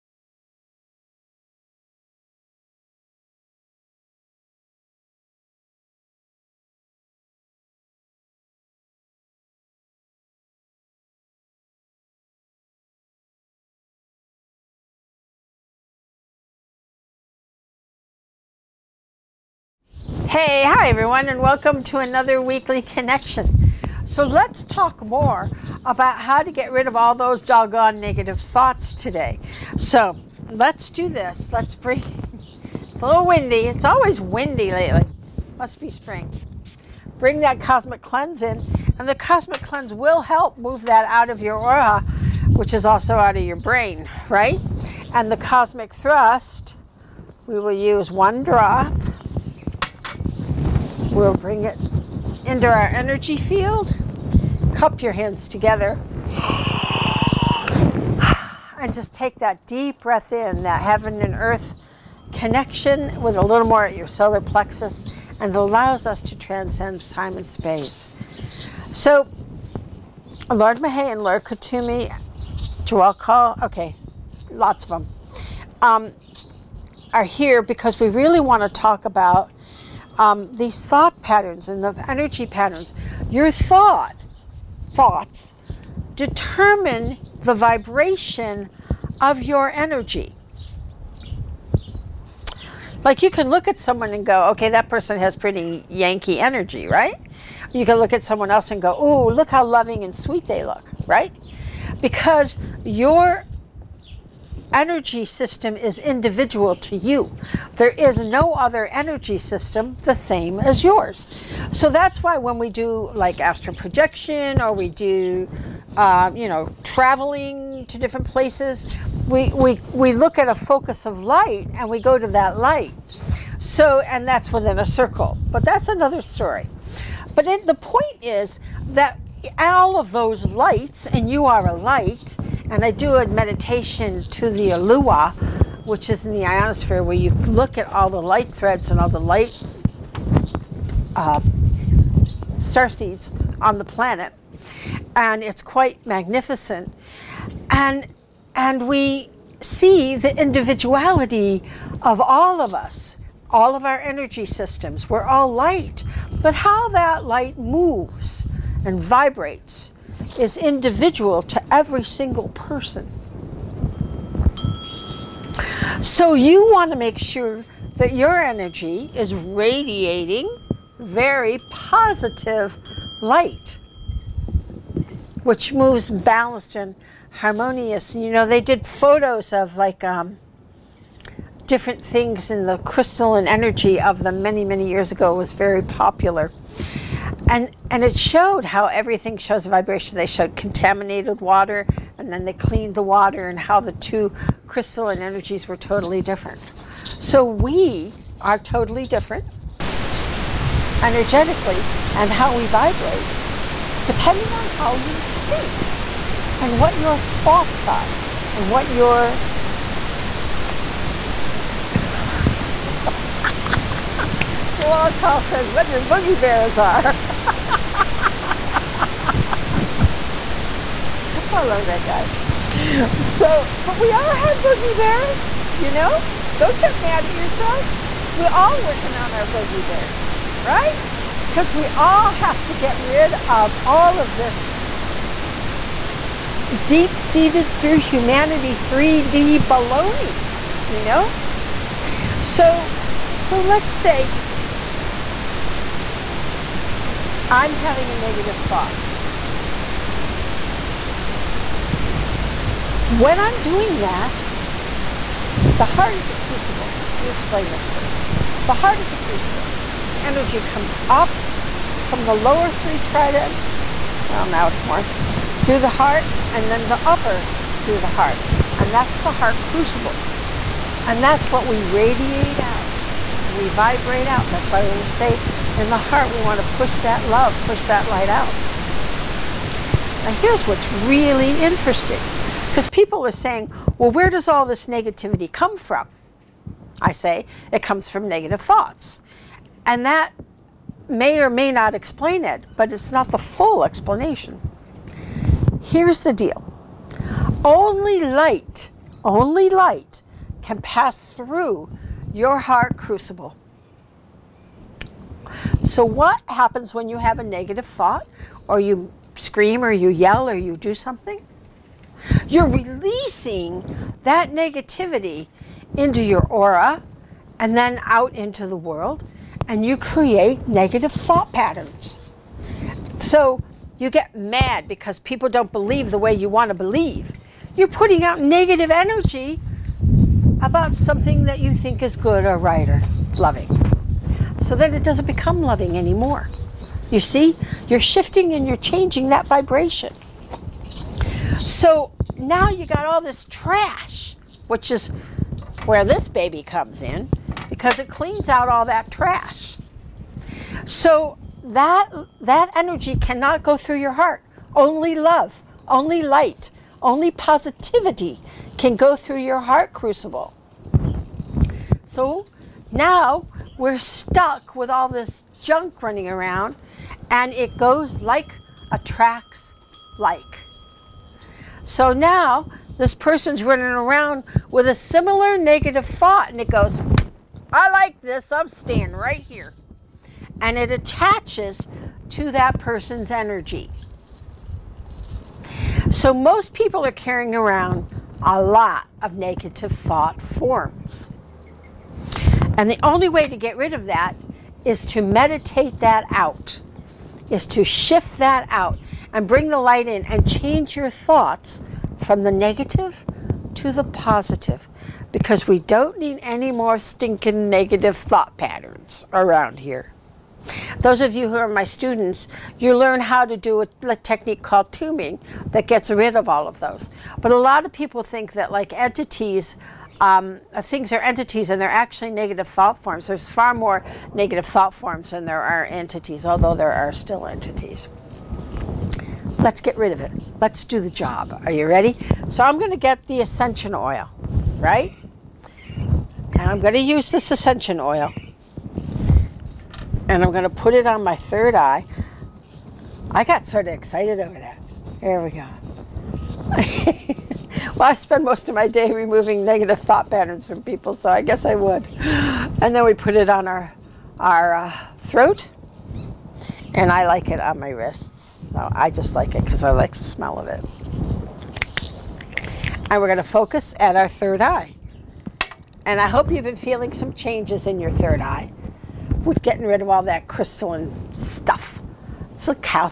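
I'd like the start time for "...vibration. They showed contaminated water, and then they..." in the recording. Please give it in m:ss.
3:09.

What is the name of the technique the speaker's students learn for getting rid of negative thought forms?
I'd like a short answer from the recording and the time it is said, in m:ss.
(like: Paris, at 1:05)
tombing, at 6:54.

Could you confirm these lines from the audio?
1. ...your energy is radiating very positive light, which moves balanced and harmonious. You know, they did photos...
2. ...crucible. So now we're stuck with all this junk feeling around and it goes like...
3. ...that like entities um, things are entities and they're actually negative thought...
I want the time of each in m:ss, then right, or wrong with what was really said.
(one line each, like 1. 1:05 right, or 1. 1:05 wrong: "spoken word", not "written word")
1. 2:48 right
2. 5:59 wrong: "running", not "feeling"
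3. 6:58 right.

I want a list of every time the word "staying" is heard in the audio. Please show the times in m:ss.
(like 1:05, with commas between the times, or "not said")
6:18.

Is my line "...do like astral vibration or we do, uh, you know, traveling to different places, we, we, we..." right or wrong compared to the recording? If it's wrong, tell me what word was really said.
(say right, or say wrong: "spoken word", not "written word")
wrong: "projection", not "vibration".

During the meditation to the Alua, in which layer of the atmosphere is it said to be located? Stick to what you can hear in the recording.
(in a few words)
ionosphere.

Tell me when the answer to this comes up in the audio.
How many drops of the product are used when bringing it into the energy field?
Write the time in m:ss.
0:48.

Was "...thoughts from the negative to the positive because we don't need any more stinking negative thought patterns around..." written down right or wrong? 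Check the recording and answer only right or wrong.
right.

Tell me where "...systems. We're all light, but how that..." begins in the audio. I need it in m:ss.
2:34.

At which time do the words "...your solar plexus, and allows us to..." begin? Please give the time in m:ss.
1:03.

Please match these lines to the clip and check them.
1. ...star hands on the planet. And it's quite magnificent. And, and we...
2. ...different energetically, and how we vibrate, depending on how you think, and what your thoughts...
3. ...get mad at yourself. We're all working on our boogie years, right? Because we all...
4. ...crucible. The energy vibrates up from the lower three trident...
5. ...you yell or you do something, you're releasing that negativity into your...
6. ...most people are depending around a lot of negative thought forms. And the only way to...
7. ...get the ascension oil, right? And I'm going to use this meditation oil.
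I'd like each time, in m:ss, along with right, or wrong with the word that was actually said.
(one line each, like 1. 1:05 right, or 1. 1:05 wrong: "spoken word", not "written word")
1. 2:22 wrong: "seeds", not "hands"
2. 3:19 right
3. 3:46 wrong: "bears", not "years"
4. 4:19 wrong: "comes", not "vibrates"
5. 5:09 right
6. 6:26 wrong: "carrying", not "depending"
7. 7:12 wrong: "ascension", not "meditation".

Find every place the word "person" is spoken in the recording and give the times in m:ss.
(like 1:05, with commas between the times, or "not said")
1:34, 2:42, 6:13, 6:22.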